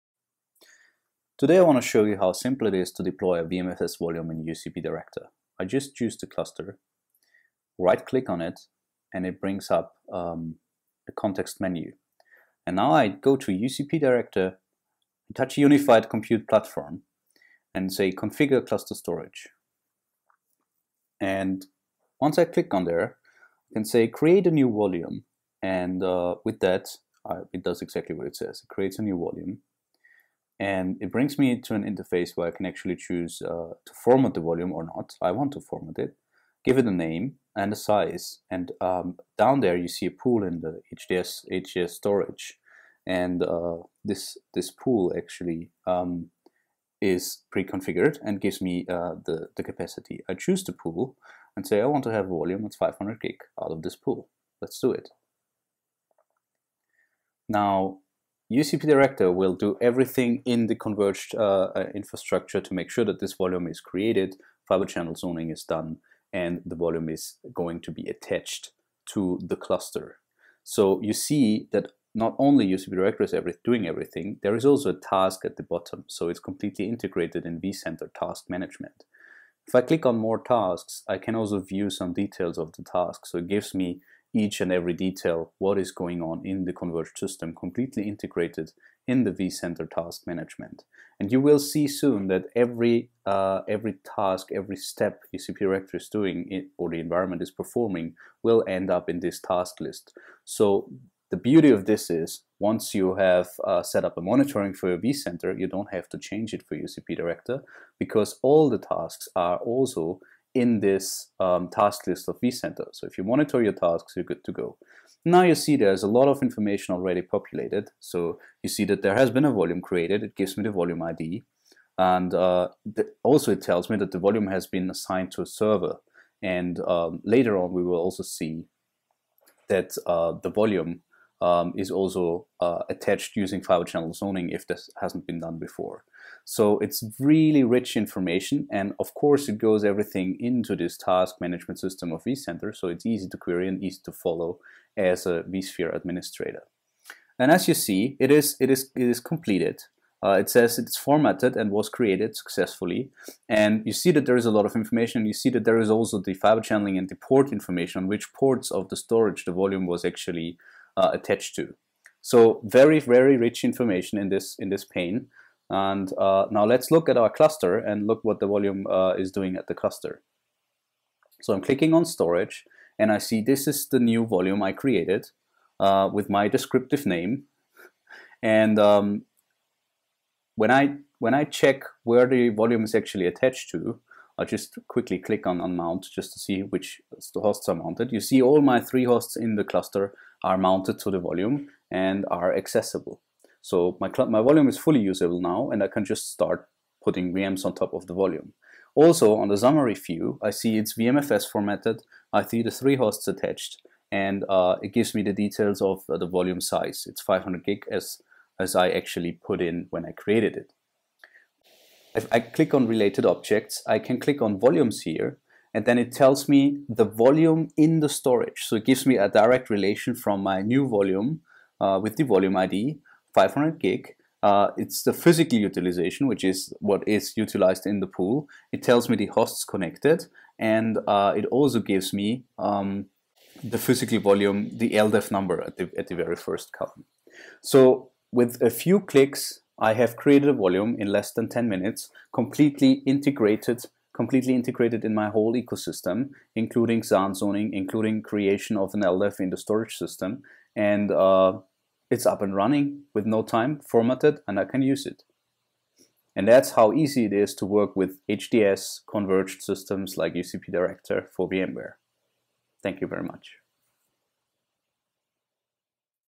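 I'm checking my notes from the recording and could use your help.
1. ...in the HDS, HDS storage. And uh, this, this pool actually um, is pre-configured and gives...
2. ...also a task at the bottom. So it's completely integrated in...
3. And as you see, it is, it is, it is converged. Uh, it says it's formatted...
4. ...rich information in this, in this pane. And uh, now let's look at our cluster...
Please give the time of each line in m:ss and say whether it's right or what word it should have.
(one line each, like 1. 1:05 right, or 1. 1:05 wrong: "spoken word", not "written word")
1. 0:40 right
2. 1:14 right
3. 2:27 wrong: "completed", not "converged"
4. 2:43 right.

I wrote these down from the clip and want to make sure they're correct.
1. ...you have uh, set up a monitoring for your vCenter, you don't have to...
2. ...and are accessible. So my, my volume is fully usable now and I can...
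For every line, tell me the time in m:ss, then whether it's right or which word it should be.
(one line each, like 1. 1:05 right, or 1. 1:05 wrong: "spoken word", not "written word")
1. 1:42 right
2. 3:11 right.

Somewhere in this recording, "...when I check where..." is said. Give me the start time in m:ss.
3:01.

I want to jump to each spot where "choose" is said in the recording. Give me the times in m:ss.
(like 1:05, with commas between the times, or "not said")
0:05, 0:32, 0:50.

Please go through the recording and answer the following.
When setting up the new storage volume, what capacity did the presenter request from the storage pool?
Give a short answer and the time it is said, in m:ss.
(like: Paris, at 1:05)
500 gig, at 0:52.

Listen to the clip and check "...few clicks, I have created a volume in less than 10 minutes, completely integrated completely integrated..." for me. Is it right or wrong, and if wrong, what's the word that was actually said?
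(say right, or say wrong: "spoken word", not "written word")
right.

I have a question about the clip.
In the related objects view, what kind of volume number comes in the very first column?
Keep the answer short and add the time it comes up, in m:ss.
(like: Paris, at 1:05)
LDEV number, at 3:54.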